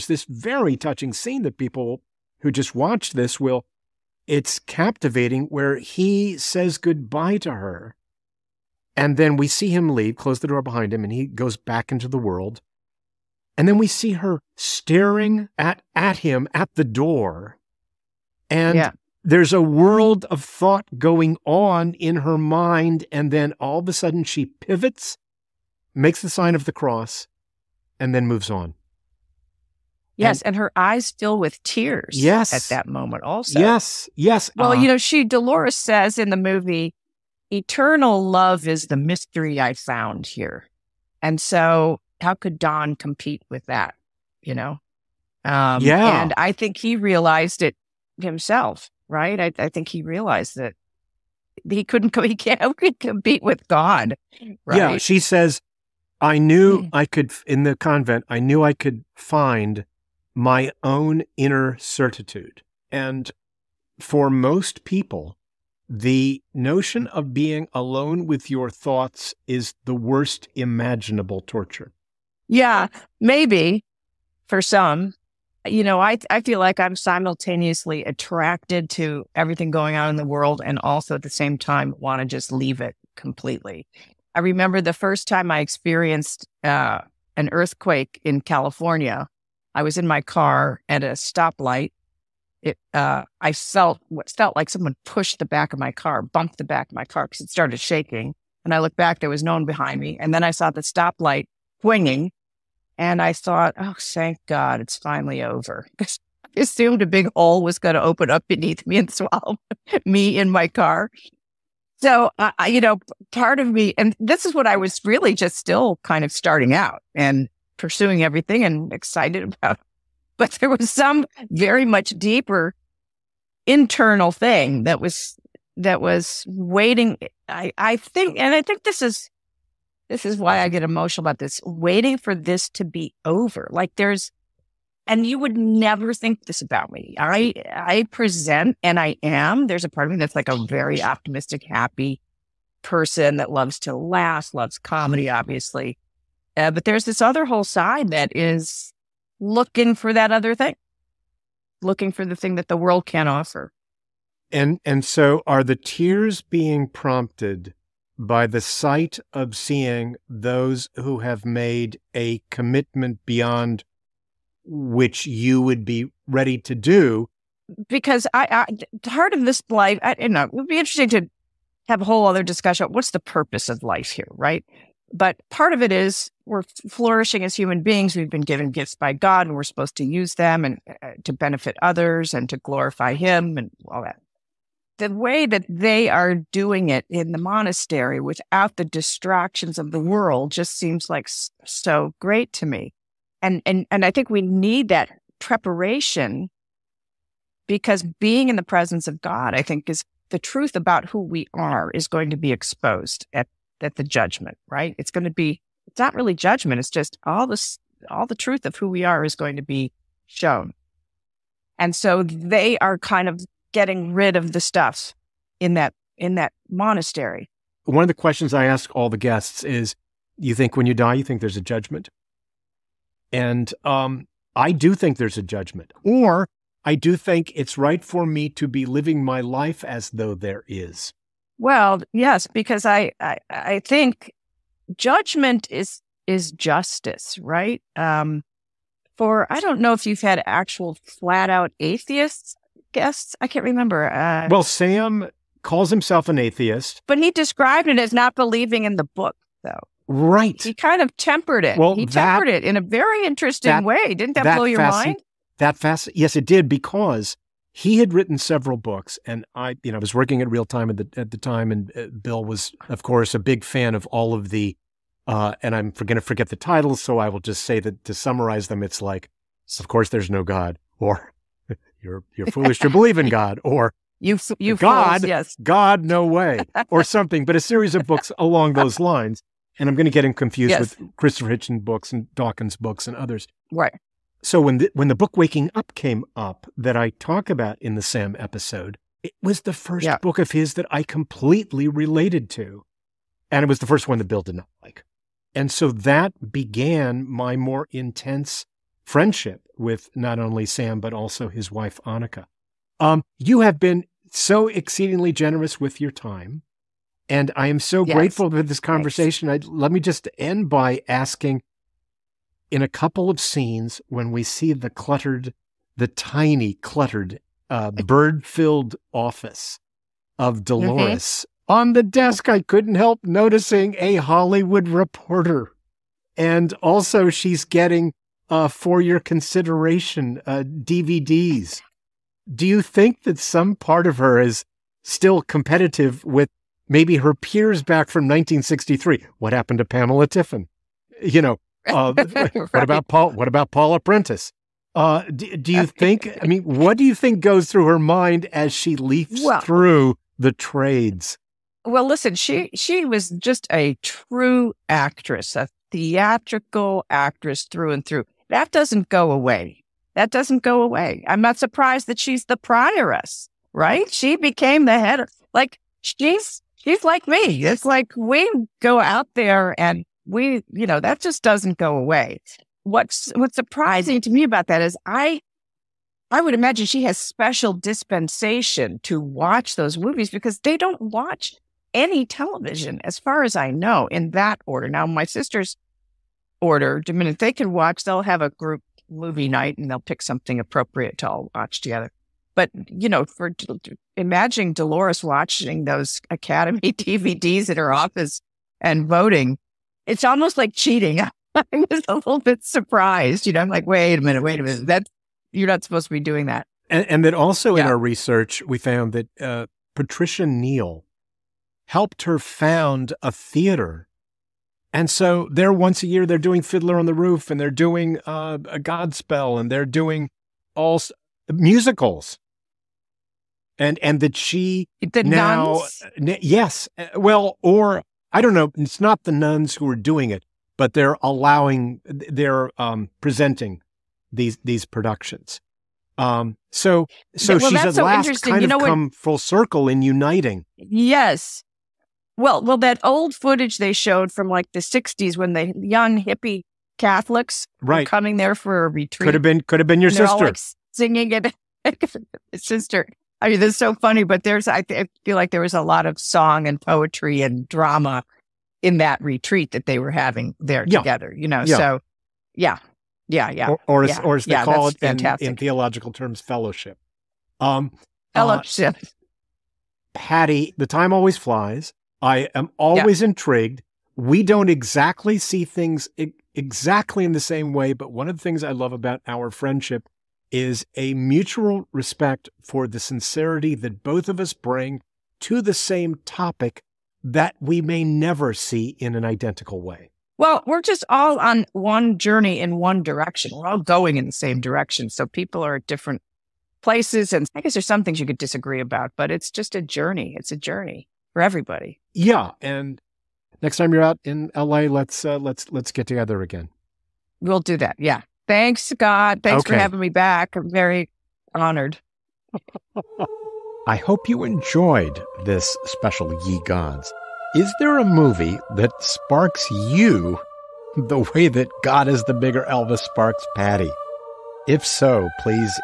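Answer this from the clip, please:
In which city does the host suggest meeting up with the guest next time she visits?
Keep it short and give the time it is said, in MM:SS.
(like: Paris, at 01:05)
LA, at 08:24.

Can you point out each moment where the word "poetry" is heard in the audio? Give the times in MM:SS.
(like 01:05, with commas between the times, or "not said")
07:36.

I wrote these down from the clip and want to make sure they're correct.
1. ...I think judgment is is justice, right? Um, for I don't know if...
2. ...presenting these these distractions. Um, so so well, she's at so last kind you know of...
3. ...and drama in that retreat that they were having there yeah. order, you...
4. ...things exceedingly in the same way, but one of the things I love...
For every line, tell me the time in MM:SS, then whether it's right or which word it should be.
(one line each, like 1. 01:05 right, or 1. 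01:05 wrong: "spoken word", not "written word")
1. 03:53 right
2. 07:13 wrong: "productions", not "distractions"
3. 07:37 wrong: "together", not "order"
4. 07:55 wrong: "exactly", not "exceedingly".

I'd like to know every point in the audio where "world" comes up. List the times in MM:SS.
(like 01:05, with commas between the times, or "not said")
00:12, 00:19, 01:20, 02:32, 03:09.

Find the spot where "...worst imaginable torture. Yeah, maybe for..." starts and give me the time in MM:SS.
01:09.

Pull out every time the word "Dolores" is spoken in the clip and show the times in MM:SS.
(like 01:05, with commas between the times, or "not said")
00:35, 05:20, 06:34.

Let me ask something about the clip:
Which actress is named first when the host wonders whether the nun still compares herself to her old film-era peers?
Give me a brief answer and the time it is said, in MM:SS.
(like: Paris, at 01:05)
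Pamela Tiffin, at 05:39.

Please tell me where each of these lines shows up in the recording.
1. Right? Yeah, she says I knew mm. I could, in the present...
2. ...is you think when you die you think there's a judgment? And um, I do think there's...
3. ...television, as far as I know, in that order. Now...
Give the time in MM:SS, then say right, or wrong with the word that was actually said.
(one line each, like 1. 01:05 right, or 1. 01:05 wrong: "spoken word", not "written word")
1. 00:54 wrong: "convent", not "present"
2. 03:39 right
3. 06:22 right.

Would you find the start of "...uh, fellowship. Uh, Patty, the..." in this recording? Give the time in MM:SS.
07:48.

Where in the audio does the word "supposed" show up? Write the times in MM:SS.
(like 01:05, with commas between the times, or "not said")
02:59, 06:45.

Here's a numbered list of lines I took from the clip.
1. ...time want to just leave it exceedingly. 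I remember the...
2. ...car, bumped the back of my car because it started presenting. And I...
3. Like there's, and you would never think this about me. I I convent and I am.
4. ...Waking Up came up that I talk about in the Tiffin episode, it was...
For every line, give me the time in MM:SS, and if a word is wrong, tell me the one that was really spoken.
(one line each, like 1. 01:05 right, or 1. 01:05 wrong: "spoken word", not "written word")
1. 01:21 wrong: "completely", not "exceedingly"
2. 01:35 wrong: "shaking", not "presenting"
3. 02:13 wrong: "present", not "convent"
4. 04:45 wrong: "Sam", not "Tiffin".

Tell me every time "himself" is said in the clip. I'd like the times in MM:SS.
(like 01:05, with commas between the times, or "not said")
00:48, 04:05.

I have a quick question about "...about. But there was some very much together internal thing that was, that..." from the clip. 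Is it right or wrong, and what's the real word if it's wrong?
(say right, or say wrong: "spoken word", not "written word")
wrong: "deeper", not "together".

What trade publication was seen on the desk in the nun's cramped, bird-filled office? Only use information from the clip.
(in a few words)
Hollywood Reporter.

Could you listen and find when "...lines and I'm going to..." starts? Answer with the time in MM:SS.
04:38.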